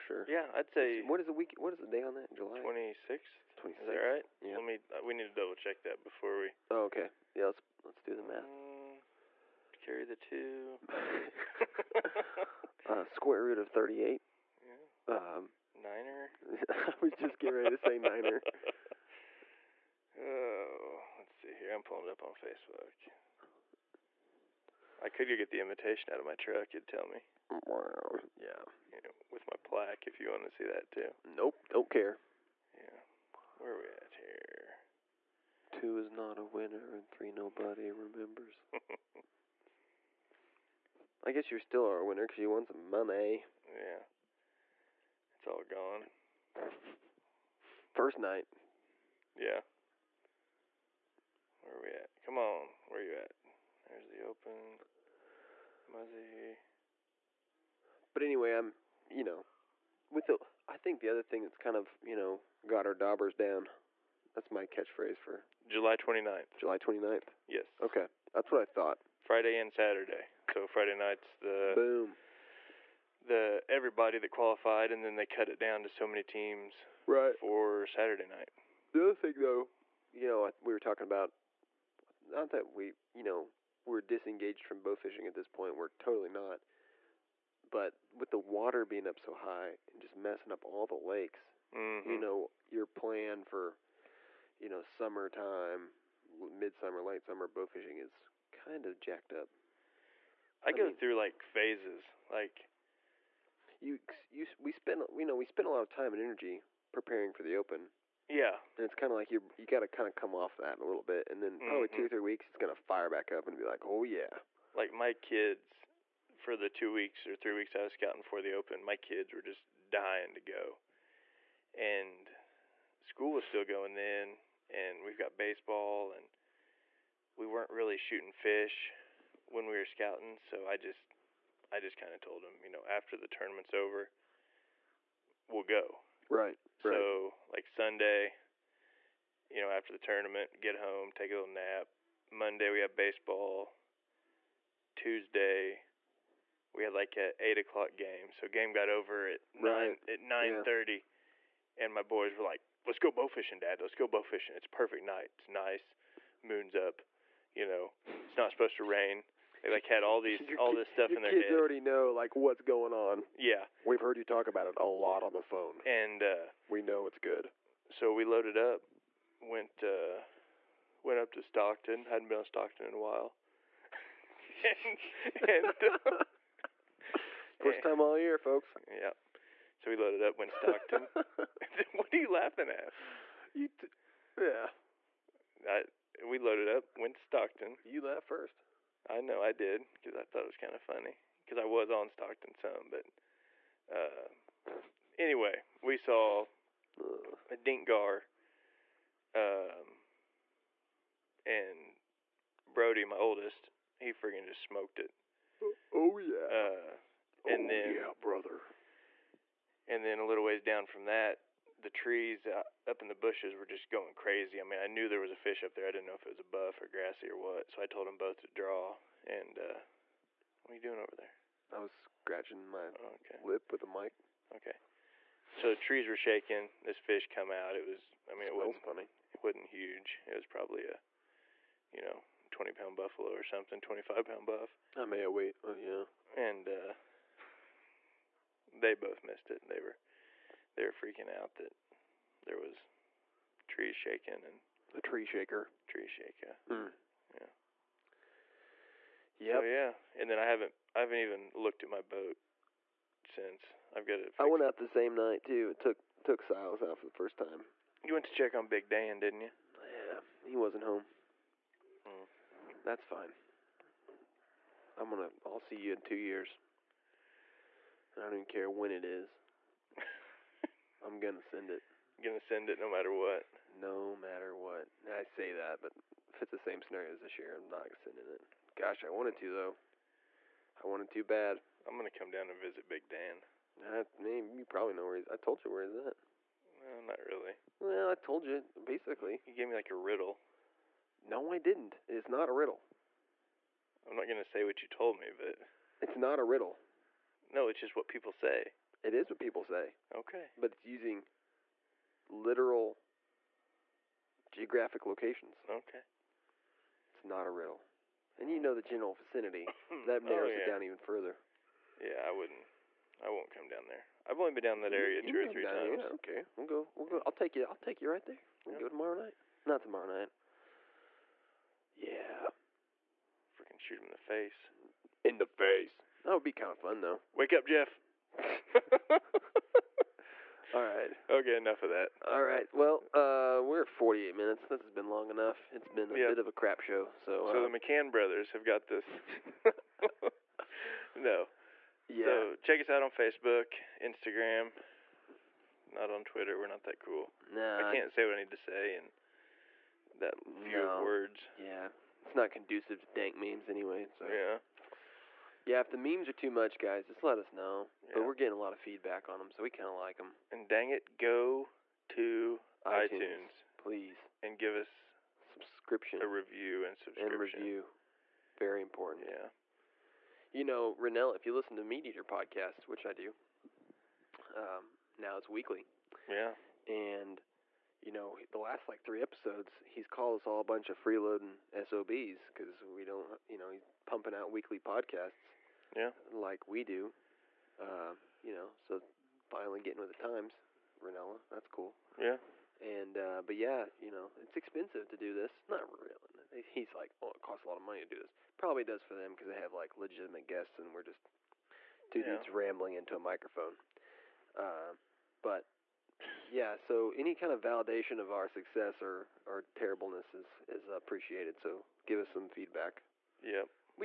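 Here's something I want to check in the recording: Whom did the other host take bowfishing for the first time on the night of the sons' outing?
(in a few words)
Silas.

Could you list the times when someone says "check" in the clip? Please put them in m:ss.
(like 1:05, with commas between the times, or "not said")
0:05, 4:18, 5:42.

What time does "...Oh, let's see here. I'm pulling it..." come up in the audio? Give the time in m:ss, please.
0:20.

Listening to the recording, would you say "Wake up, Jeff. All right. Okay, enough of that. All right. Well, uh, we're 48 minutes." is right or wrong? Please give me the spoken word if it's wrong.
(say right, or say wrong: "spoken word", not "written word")
right.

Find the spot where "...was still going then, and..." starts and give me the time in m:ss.
2:03.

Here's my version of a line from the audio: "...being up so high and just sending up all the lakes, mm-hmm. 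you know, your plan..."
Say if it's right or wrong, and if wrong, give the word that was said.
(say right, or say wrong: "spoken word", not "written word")
wrong: "messing", not "sending".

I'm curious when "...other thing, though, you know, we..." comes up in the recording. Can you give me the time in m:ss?
1:19.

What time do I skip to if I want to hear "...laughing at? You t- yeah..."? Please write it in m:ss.
3:02.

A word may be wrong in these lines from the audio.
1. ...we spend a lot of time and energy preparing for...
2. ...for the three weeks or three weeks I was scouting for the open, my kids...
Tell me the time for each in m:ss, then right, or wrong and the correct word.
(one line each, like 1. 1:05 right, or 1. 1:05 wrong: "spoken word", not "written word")
1. 1:45 right
2. 1:56 wrong: "two", not "three".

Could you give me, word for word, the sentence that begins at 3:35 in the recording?
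I didn't know if it was a buff or grassy or what.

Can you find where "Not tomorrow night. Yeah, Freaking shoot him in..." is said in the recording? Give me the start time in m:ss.
5:19.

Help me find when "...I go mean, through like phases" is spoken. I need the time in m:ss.
1:40.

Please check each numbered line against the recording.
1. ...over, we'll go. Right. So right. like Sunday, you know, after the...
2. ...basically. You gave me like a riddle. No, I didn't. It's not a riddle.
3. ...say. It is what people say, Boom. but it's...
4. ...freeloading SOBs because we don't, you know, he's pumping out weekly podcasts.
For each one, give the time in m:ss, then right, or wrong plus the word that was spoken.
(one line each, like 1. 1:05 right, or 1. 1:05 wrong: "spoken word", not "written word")
1. 2:13 right
2. 4:48 right
3. 4:58 wrong: "Okay", not "Boom"
4. 6:21 right.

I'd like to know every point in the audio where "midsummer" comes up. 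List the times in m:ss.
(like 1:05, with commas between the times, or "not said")
1:36.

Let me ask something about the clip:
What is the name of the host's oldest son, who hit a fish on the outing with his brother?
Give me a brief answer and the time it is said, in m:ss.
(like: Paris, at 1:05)
Brody, at 3:22.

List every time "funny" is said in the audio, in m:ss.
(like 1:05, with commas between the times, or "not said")
3:10, 3:48.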